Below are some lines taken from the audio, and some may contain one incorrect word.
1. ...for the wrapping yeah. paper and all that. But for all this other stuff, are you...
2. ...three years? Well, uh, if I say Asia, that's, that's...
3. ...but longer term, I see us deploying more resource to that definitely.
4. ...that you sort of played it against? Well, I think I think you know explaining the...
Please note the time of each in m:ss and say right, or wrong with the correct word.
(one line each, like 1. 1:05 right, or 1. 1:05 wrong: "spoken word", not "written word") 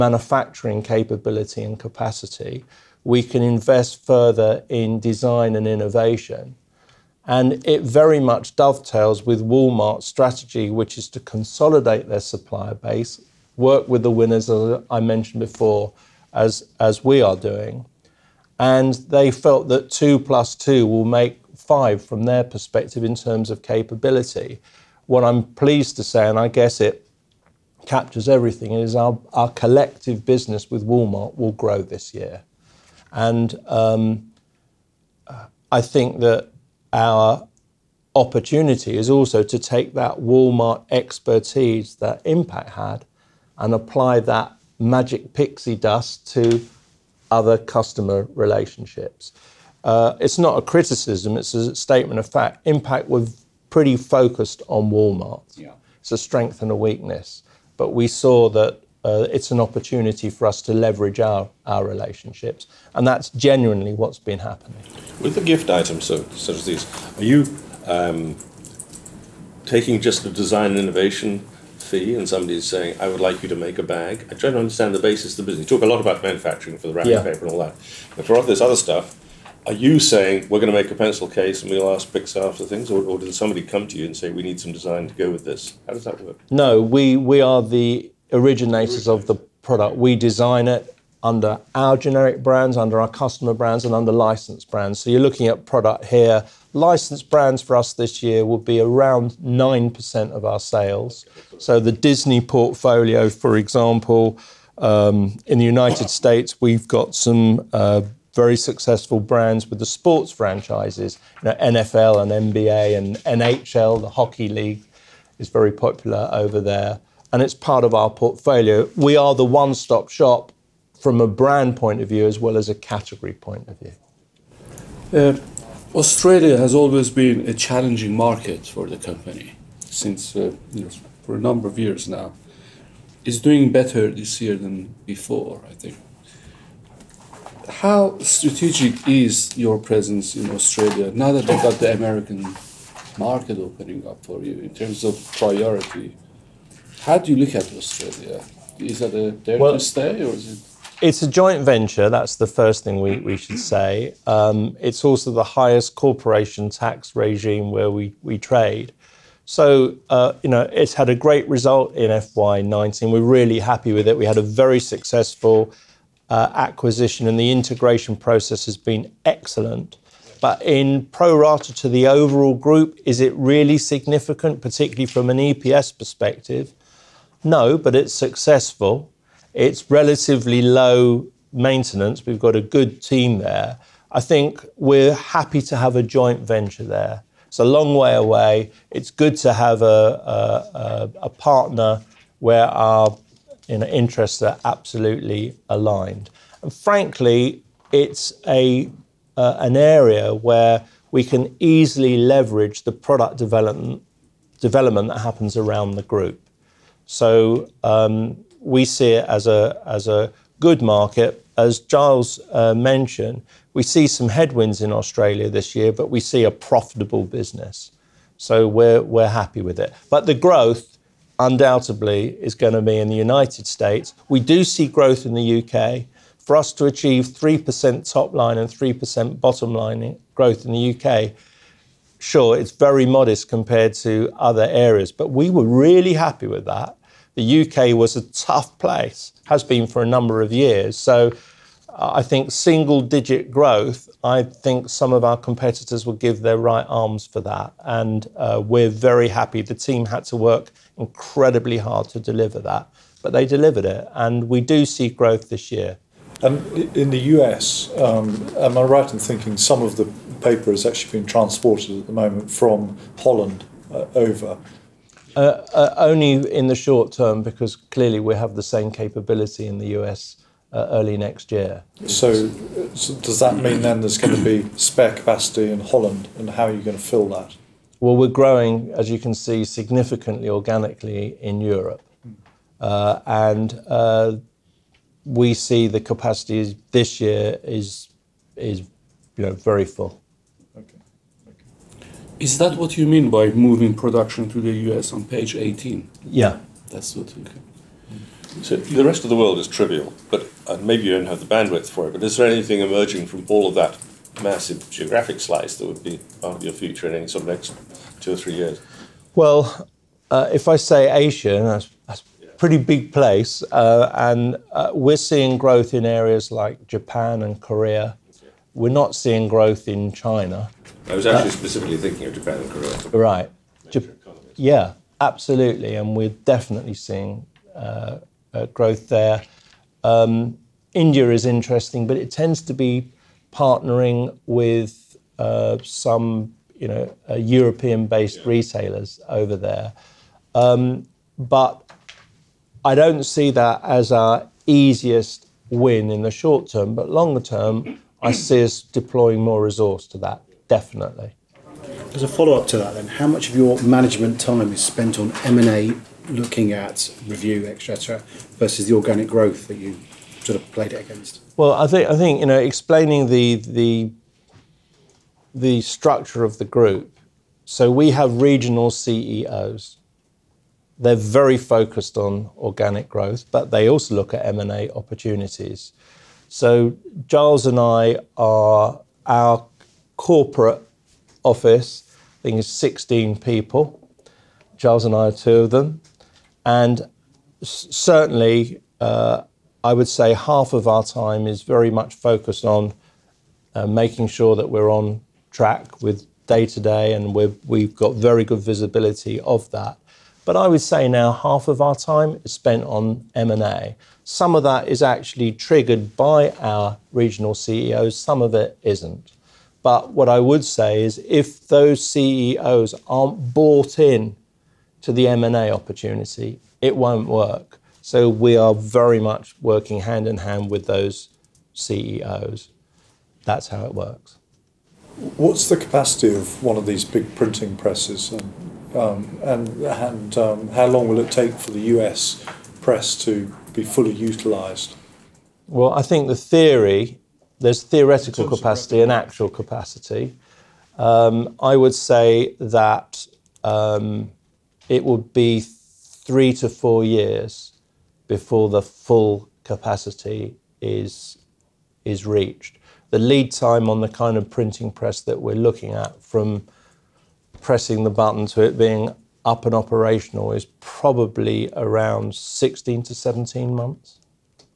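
1. 1:16 right
2. 5:08 right
3. 5:46 right
4. 5:59 right.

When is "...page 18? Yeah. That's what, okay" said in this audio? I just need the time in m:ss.
4:55.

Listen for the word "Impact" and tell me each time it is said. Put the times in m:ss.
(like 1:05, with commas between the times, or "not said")
0:42, 0:52.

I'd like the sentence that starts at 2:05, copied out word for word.
Uh, Australia has always been a challenging market for the company since uh, know, for a number of years now.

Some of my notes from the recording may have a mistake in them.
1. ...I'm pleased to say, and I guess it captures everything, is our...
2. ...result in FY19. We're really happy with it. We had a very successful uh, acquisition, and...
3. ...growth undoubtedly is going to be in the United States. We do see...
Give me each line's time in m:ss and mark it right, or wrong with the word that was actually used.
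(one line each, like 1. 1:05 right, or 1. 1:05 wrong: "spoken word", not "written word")
1. 0:25 right
2. 2:41 right
3. 3:40 right.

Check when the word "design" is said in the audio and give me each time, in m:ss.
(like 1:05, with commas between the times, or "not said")
0:05, 1:10, 1:24, 1:30.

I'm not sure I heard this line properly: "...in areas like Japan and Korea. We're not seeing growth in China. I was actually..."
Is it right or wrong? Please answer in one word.
right.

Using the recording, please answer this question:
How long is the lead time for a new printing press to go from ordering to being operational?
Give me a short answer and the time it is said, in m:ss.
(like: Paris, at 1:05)
16 to 17 months, at 7:42.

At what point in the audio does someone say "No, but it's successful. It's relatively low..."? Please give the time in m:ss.
2:57.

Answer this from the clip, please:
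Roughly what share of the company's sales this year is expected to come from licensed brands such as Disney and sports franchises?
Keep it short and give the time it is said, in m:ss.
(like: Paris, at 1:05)
9%, at 1:39.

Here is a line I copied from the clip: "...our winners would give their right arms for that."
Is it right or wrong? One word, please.
wrong.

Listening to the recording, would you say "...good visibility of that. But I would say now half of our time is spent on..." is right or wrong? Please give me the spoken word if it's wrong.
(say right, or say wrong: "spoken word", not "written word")
right.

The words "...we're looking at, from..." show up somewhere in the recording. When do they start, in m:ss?
7:35.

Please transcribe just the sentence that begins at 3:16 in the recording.
And frankly, it's a, uh, an area where we can easily leverage the product development, development that happens around the group.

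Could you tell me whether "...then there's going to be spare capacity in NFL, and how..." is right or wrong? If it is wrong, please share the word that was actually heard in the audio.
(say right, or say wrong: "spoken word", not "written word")
wrong: "Holland", not "NFL".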